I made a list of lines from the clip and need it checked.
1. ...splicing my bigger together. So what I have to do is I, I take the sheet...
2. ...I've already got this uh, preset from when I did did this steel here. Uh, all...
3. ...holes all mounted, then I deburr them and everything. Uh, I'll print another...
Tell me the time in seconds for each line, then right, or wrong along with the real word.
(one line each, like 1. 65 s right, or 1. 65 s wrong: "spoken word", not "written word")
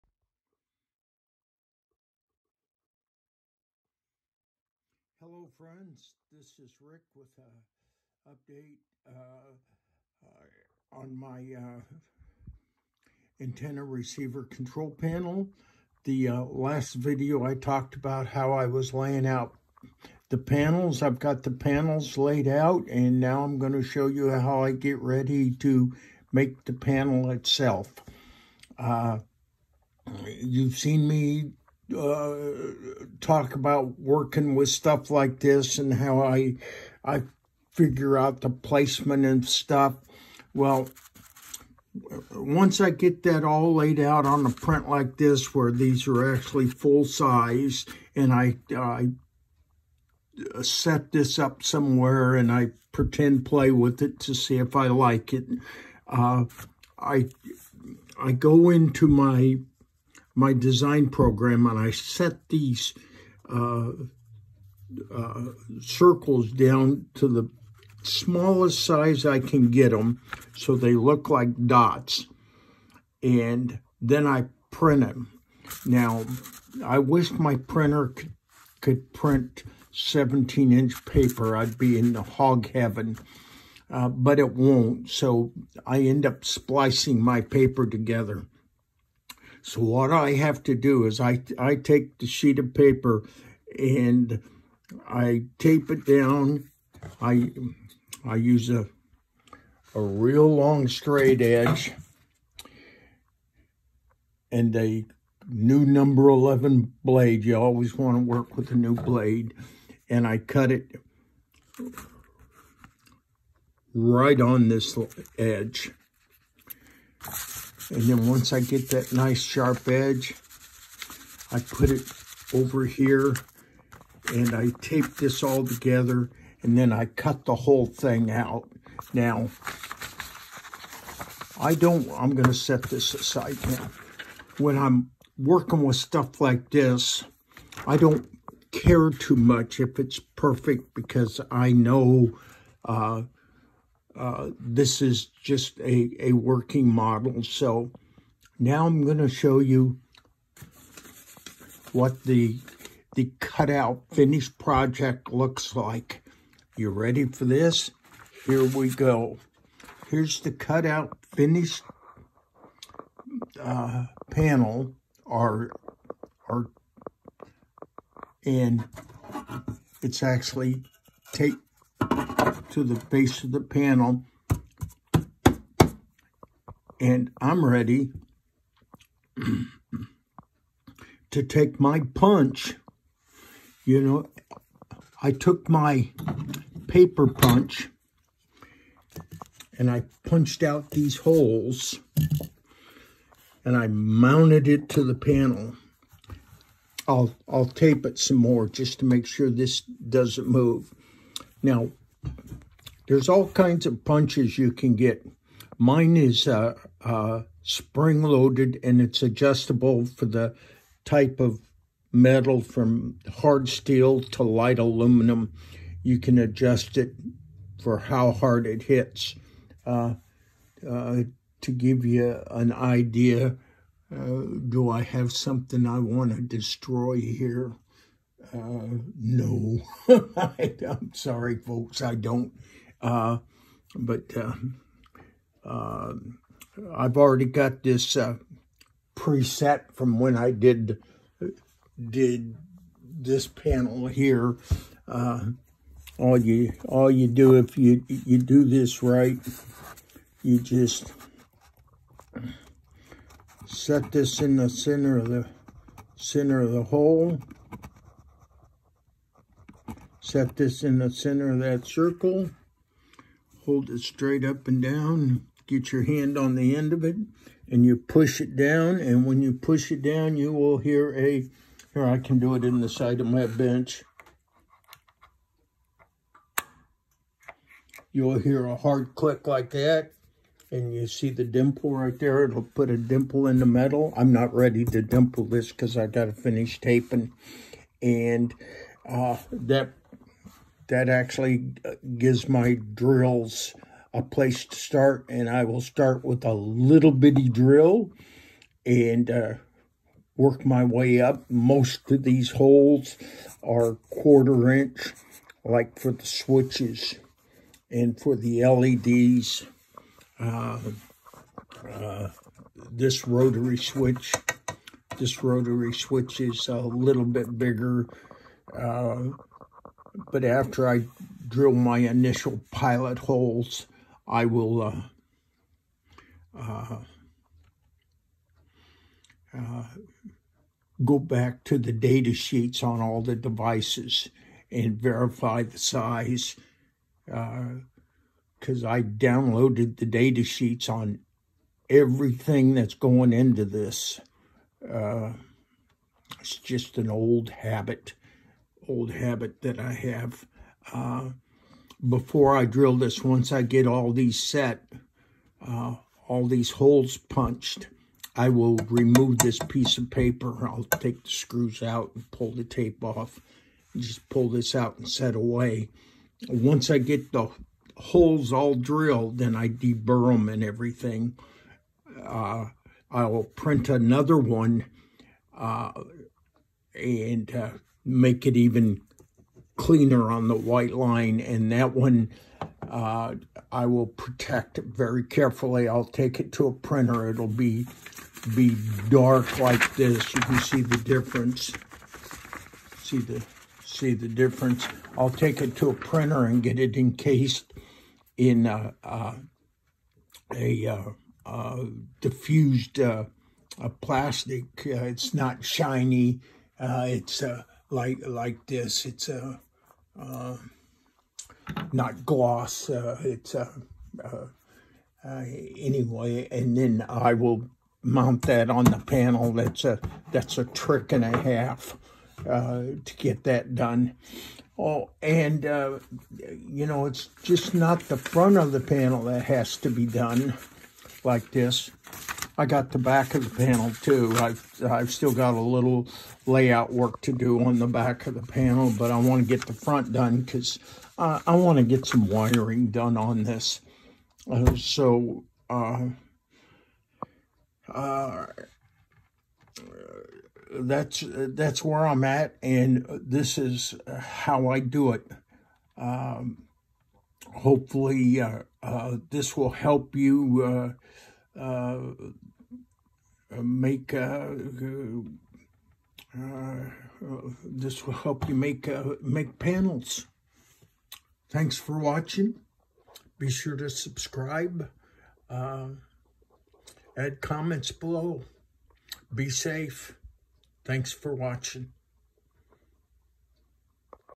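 1. 86 s wrong: "paper", not "bigger"
2. 236 s wrong: "panel", not "steel"
3. 367 s wrong: "drilled", not "mounted".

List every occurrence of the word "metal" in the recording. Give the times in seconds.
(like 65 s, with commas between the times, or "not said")
212 s, 283 s.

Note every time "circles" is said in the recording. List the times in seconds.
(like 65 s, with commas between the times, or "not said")
65 s, 261 s.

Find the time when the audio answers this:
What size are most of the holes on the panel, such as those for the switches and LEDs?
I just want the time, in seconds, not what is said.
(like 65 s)
304 s.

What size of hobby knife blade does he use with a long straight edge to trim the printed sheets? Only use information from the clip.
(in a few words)
number 11.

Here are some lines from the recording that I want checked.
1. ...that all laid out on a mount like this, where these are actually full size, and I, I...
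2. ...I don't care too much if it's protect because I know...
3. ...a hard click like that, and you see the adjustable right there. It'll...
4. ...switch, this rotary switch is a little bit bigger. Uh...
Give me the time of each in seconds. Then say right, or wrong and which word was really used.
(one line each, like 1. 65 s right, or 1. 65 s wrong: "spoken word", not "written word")
1. 43 s wrong: "print", not "mount"
2. 137 s wrong: "perfect", not "protect"
3. 278 s wrong: "dimple", not "adjustable"
4. 313 s right.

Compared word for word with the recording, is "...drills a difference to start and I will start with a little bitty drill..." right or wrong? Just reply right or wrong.
wrong.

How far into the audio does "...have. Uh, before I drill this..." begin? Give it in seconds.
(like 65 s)
349 s.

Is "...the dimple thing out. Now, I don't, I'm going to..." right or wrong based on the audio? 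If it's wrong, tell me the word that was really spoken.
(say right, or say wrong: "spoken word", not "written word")
wrong: "whole", not "dimple".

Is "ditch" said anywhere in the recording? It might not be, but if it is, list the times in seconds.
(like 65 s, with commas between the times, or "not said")
not said.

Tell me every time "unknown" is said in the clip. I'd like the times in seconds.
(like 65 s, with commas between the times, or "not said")
not said.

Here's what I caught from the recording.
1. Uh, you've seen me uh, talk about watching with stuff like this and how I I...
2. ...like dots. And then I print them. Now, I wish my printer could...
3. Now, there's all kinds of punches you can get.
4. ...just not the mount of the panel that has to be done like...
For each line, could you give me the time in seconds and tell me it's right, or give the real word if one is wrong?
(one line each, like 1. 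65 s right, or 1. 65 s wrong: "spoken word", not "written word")
1. 28 s wrong: "working", not "watching"
2. 71 s right
3. 201 s right
4. 427 s wrong: "front", not "mount".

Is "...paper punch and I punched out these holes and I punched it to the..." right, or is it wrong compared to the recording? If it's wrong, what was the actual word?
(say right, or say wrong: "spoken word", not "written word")
wrong: "mounted", not "punched".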